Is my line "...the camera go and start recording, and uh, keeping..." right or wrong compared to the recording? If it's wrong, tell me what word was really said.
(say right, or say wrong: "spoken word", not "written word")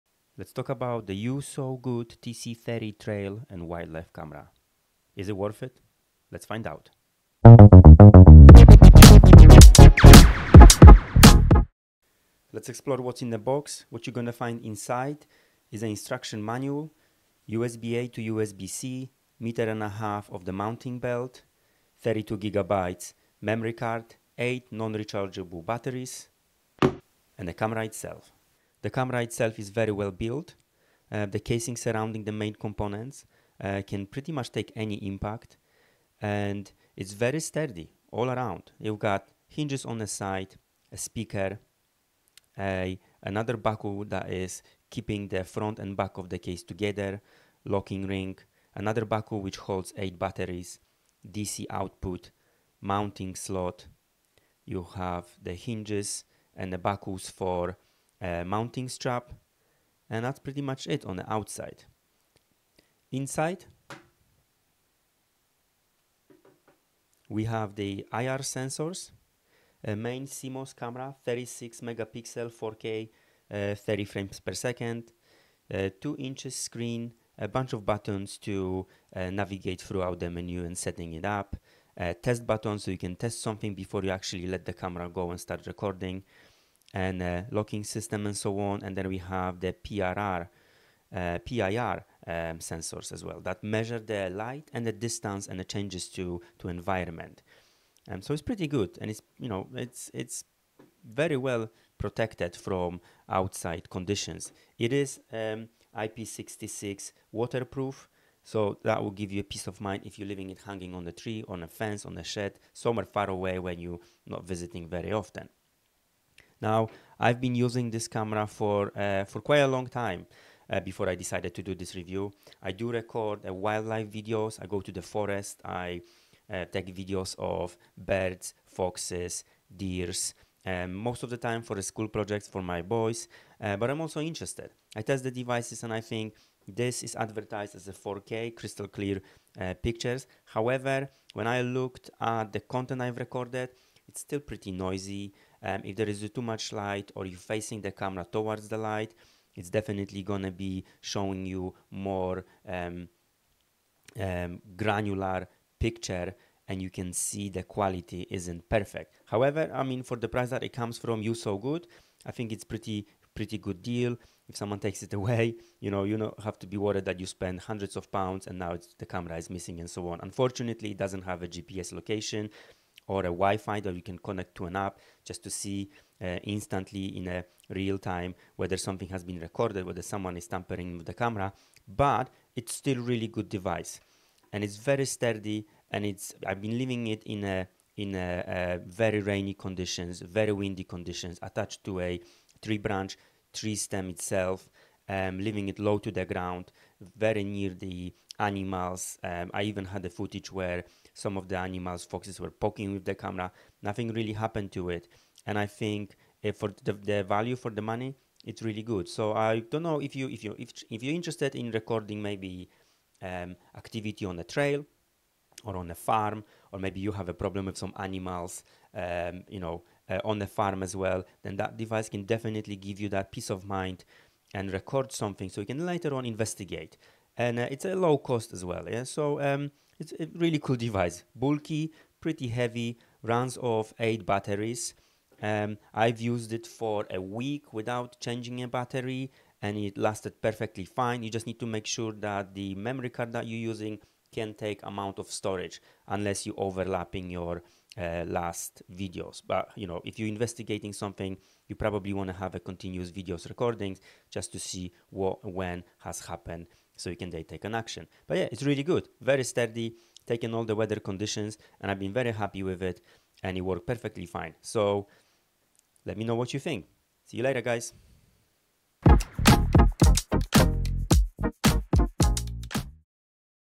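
wrong: "locking", not "keeping".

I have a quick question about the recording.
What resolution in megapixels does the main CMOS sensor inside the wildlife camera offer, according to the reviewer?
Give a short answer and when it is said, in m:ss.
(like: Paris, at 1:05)
36 megapixel, at 1:11.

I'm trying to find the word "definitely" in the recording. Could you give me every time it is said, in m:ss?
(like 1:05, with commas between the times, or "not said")
2:29, 3:42.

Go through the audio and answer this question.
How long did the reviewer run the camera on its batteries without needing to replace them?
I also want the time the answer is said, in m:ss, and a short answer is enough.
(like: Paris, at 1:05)
a week, at 3:57.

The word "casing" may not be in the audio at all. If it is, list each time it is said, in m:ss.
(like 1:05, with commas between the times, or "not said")
0:31.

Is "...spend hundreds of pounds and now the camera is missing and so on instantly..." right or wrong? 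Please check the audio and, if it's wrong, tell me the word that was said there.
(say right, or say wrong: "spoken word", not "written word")
wrong: "unfortunately", not "instantly".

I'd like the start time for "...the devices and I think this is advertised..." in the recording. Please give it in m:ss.
2:15.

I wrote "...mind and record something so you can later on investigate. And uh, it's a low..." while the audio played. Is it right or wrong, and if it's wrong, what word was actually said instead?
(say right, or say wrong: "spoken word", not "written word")
right.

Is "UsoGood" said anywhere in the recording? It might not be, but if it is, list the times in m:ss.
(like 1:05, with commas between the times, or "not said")
0:01, 2:41.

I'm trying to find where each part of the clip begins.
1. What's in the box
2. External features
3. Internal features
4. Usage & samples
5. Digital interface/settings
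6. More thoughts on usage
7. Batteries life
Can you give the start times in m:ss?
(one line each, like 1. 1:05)
1. 0:12
2. 0:29
3. 1:03
4. 1:55
5. 2:41
6. 3:07
7. 3:53.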